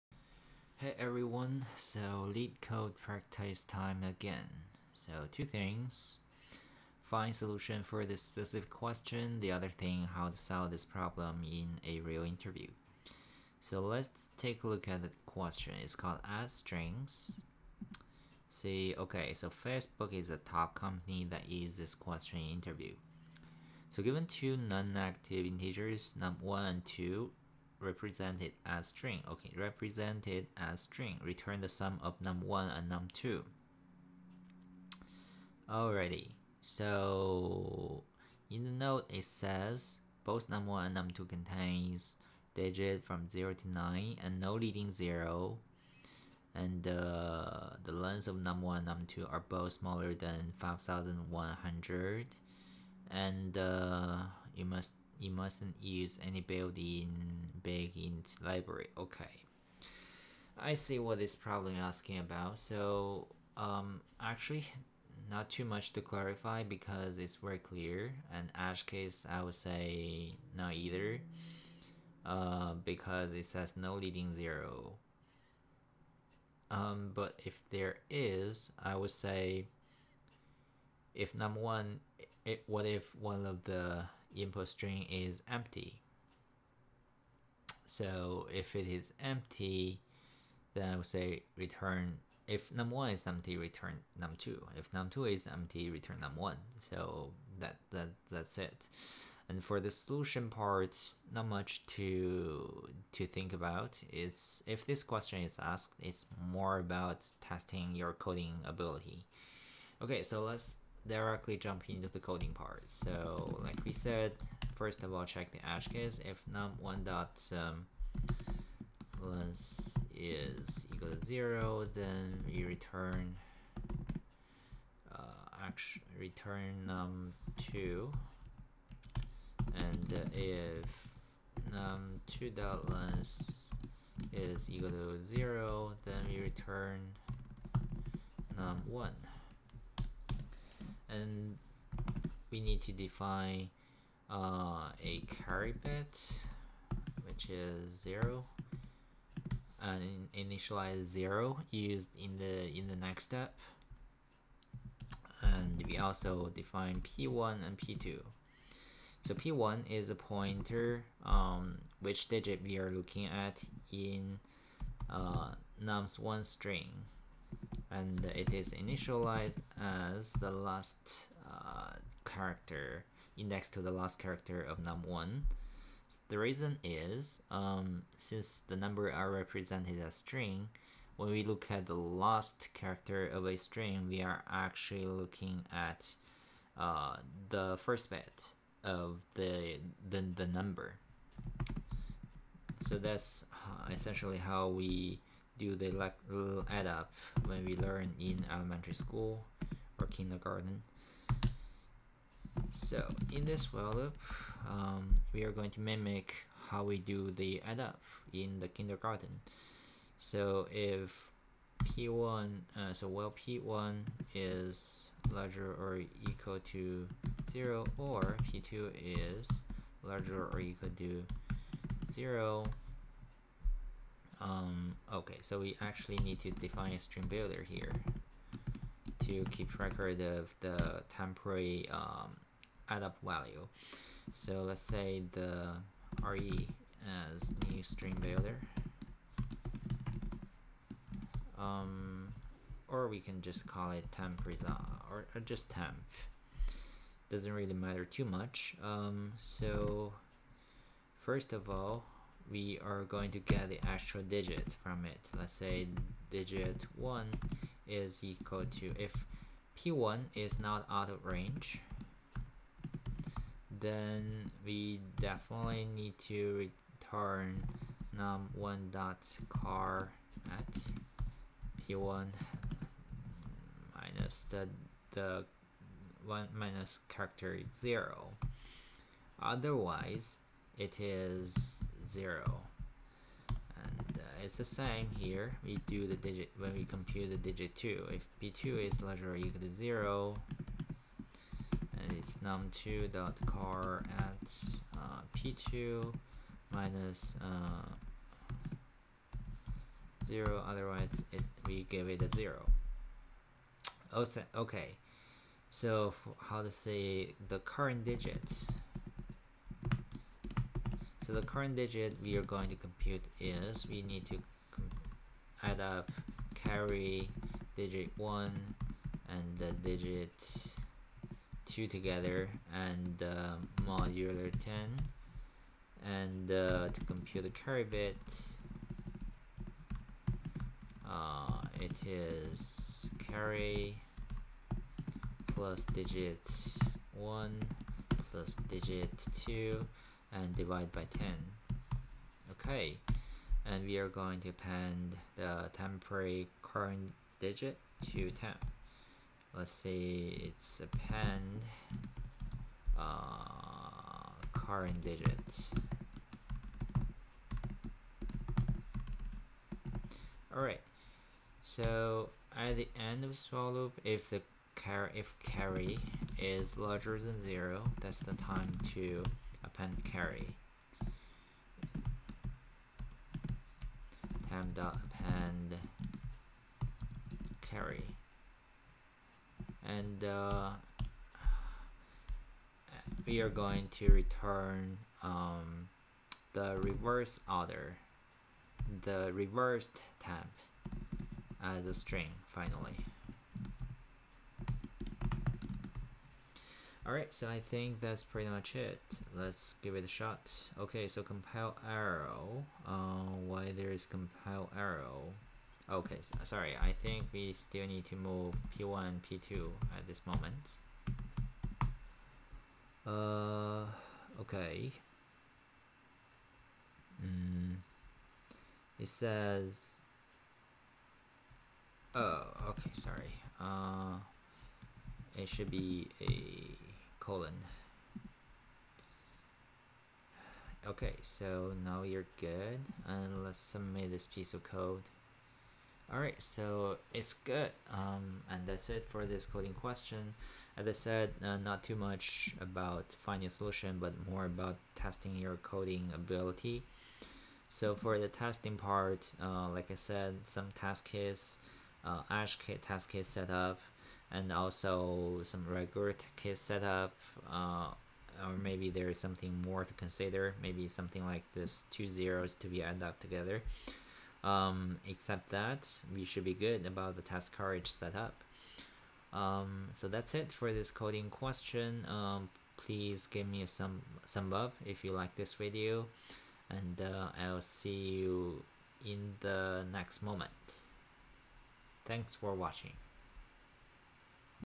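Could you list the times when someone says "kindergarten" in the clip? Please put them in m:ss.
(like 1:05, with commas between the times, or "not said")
3:20, 3:28.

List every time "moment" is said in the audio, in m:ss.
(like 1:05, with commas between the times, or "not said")
6:50, 8:00.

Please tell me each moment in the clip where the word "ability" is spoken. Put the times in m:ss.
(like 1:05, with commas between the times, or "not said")
1:48, 7:26.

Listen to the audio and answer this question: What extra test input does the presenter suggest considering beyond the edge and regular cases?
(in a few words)
two zeros.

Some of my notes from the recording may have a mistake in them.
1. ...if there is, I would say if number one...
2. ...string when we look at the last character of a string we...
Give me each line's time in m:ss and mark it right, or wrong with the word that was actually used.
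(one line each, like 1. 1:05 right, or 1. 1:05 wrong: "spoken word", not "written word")
1. 1:17 right
2. 3:00 right.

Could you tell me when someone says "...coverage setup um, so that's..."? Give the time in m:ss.
7:47.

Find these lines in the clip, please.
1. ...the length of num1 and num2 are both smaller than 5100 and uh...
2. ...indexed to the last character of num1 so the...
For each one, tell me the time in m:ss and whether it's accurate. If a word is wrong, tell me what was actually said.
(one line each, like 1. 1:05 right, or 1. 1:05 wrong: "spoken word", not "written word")
1. 0:47 right
2. 2:53 right.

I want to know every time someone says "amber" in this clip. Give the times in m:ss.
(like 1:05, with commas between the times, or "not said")
not said.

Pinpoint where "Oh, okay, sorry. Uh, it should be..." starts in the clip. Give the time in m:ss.
7:02.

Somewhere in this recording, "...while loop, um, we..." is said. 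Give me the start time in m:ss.
3:23.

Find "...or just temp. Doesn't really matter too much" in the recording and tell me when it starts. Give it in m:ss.
4:05.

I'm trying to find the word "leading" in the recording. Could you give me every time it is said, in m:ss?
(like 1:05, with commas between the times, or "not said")
0:44, 1:13.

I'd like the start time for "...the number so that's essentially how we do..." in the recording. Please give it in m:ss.
3:10.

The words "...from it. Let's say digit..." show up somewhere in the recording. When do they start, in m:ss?
4:14.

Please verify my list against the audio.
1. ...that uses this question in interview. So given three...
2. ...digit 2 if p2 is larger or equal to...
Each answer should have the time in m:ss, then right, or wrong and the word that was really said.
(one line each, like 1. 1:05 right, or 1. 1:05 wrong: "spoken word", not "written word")
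1. 0:21 wrong: "two", not "three"
2. 4:47 right.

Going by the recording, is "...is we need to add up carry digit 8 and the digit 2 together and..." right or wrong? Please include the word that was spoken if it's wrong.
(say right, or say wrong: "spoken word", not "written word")
wrong: "1", not "8".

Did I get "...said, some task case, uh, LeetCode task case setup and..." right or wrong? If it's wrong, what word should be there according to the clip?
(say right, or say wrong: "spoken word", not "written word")
wrong: "Ash", not "LeetCode".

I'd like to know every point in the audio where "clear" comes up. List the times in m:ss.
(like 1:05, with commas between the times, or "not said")
1:07.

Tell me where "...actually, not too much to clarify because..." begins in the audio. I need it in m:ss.
1:04.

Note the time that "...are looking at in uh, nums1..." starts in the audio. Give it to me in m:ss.
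2:42.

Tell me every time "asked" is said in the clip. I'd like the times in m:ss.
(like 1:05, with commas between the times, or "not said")
1:45.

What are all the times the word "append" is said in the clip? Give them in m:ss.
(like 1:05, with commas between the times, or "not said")
5:44, 5:50, 6:09, 6:15.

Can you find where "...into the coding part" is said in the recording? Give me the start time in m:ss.
1:51.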